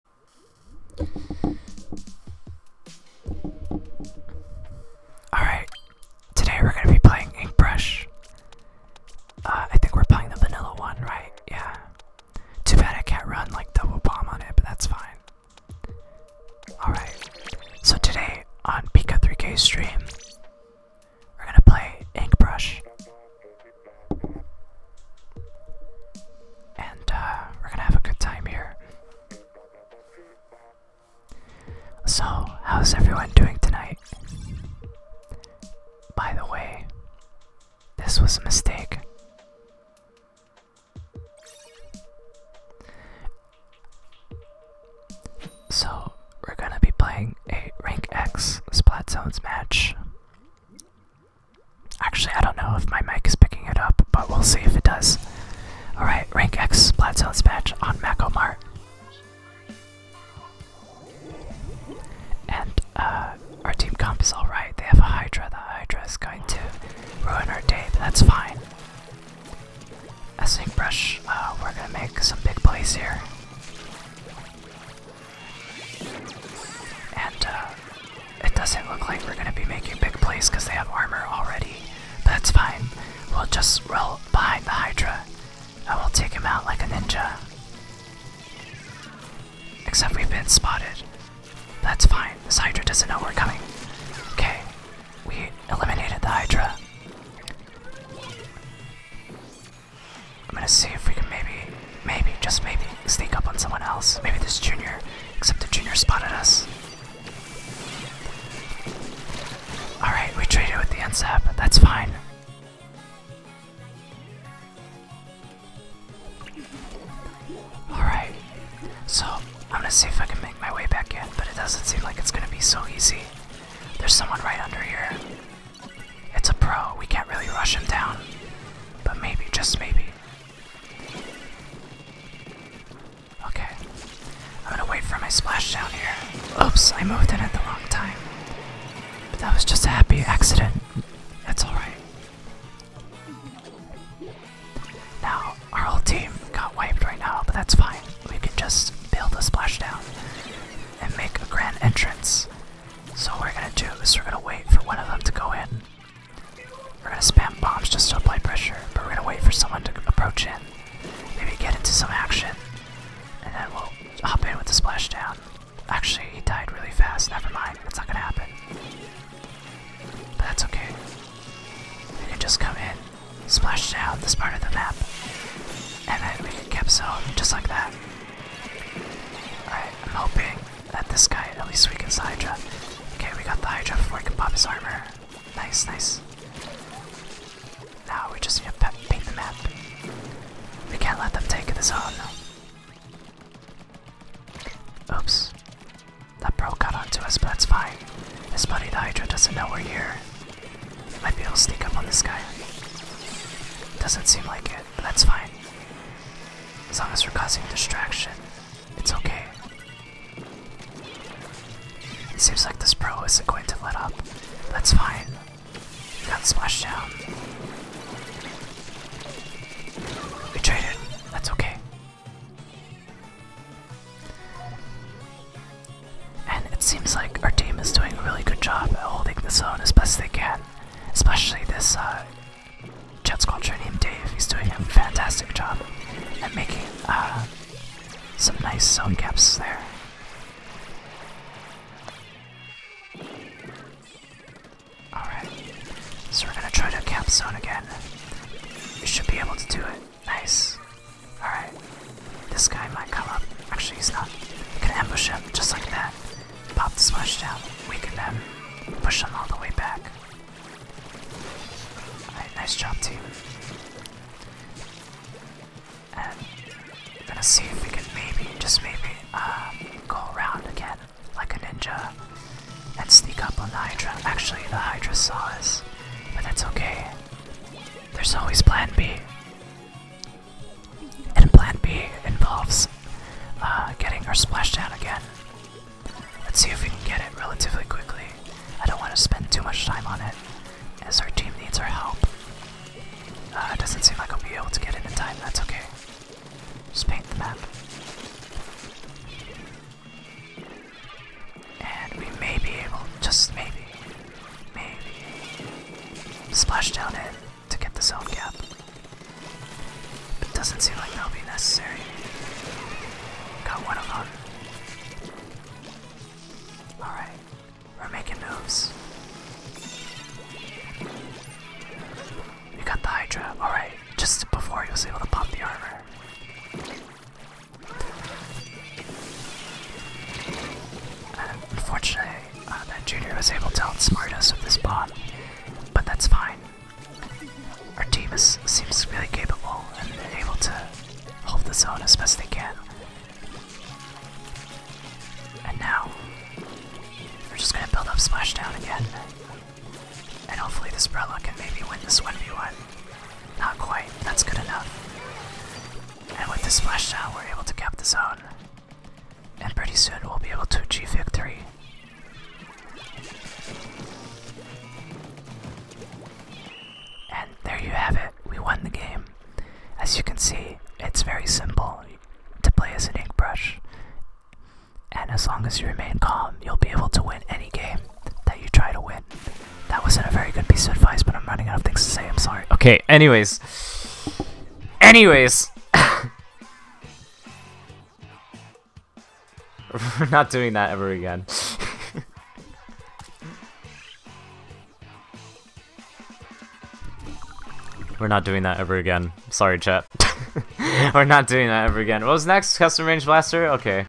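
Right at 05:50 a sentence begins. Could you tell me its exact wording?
And hopefully this Brella can maybe win this 1v1.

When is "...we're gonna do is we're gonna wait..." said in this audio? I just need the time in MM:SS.
02:33.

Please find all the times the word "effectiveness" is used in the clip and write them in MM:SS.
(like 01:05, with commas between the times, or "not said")
not said.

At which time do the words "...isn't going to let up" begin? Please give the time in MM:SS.
03:33.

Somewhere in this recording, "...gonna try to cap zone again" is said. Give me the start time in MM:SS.
04:06.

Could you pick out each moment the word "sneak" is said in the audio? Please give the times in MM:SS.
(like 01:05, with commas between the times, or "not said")
01:43, 04:33.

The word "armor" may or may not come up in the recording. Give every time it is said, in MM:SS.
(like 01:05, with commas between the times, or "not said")
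01:20, 03:04, 05:25.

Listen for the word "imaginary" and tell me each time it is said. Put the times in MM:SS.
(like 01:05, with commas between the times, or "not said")
not said.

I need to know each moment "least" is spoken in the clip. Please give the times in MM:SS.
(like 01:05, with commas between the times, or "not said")
03:01.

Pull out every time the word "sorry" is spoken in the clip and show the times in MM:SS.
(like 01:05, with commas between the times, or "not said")
06:22, 06:39.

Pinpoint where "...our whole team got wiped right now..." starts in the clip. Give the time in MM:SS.
02:25.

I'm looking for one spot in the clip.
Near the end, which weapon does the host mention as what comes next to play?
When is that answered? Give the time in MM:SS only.
06:42.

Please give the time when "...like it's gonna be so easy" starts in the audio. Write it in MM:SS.
02:02.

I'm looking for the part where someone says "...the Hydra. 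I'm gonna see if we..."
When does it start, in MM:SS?
01:36.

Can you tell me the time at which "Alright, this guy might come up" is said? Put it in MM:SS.
04:11.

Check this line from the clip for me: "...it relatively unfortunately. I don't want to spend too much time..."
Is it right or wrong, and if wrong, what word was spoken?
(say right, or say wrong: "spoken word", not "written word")
wrong: "quickly", not "unfortunately".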